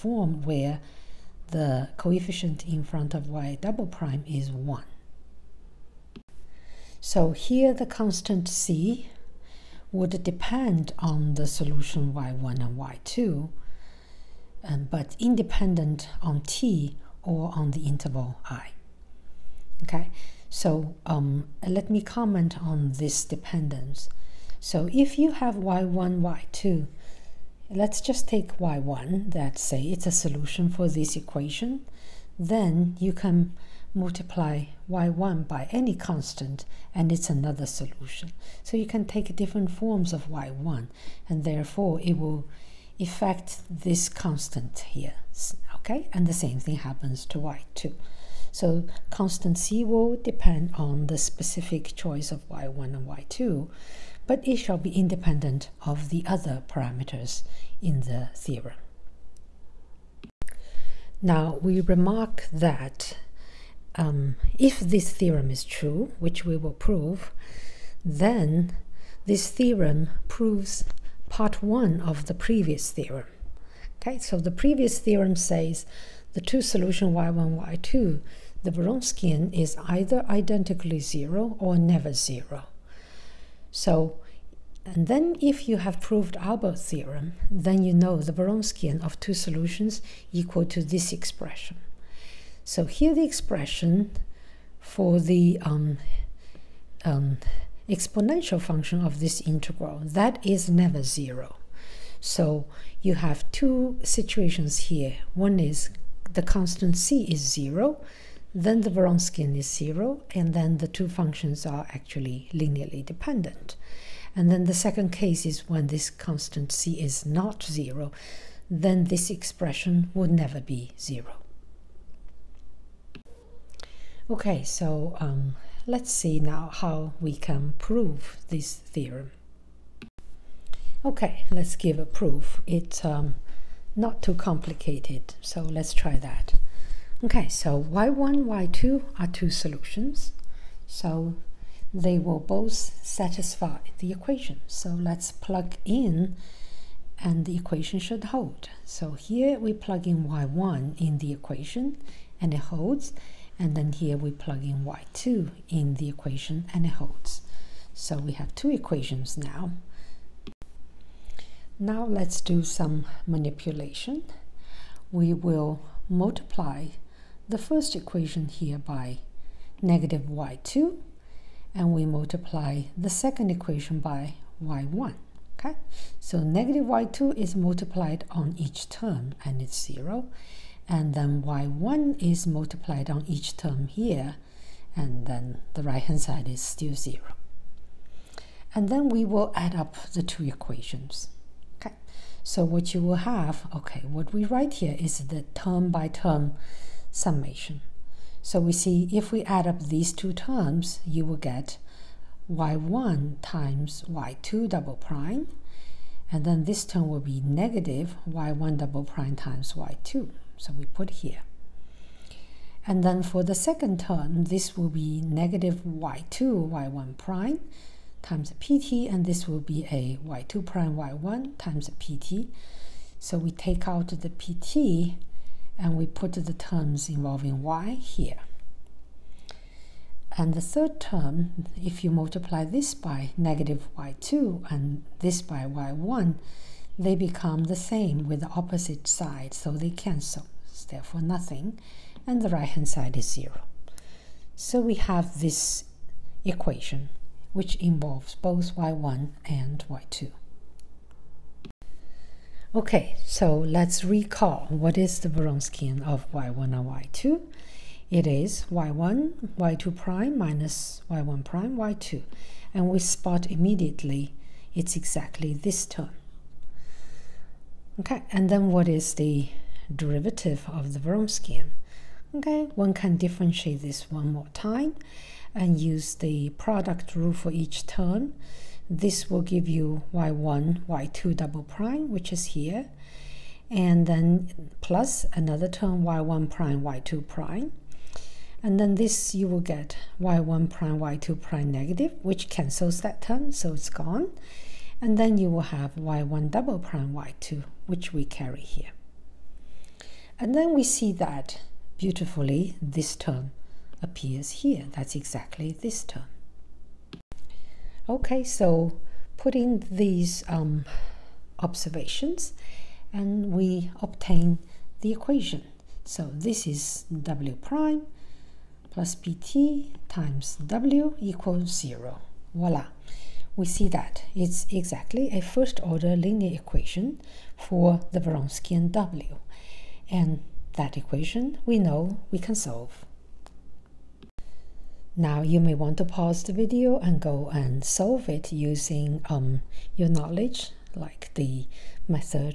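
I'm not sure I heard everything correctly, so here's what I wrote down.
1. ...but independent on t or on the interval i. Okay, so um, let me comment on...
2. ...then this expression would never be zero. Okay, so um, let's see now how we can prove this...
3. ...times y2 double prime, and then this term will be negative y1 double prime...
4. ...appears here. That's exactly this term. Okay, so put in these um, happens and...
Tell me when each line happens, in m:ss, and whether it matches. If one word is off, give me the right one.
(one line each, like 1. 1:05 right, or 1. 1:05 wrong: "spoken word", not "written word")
1. 0:14 right
2. 1:58 right
3. 3:23 right
4. 5:04 wrong: "observations", not "happens".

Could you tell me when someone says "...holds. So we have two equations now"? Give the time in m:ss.
2:36.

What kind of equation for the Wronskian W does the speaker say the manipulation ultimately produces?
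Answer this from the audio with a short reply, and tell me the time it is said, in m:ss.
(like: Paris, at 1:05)
First order linear equation, at 5:25.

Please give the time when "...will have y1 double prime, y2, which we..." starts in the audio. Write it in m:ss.
4:55.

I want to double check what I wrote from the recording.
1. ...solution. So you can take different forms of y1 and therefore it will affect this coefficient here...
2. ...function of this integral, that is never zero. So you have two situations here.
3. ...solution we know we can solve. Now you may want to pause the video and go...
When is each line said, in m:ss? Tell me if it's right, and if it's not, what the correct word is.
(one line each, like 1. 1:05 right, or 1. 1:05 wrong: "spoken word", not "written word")
1. 0:37 wrong: "constant", not "coefficient"
2. 1:38 right
3. 5:30 wrong: "equation", not "solution".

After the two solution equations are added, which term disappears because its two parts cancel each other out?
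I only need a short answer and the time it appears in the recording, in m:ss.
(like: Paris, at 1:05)
The third term, at 3:50.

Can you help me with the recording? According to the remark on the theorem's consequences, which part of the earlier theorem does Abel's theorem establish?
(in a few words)
Part one.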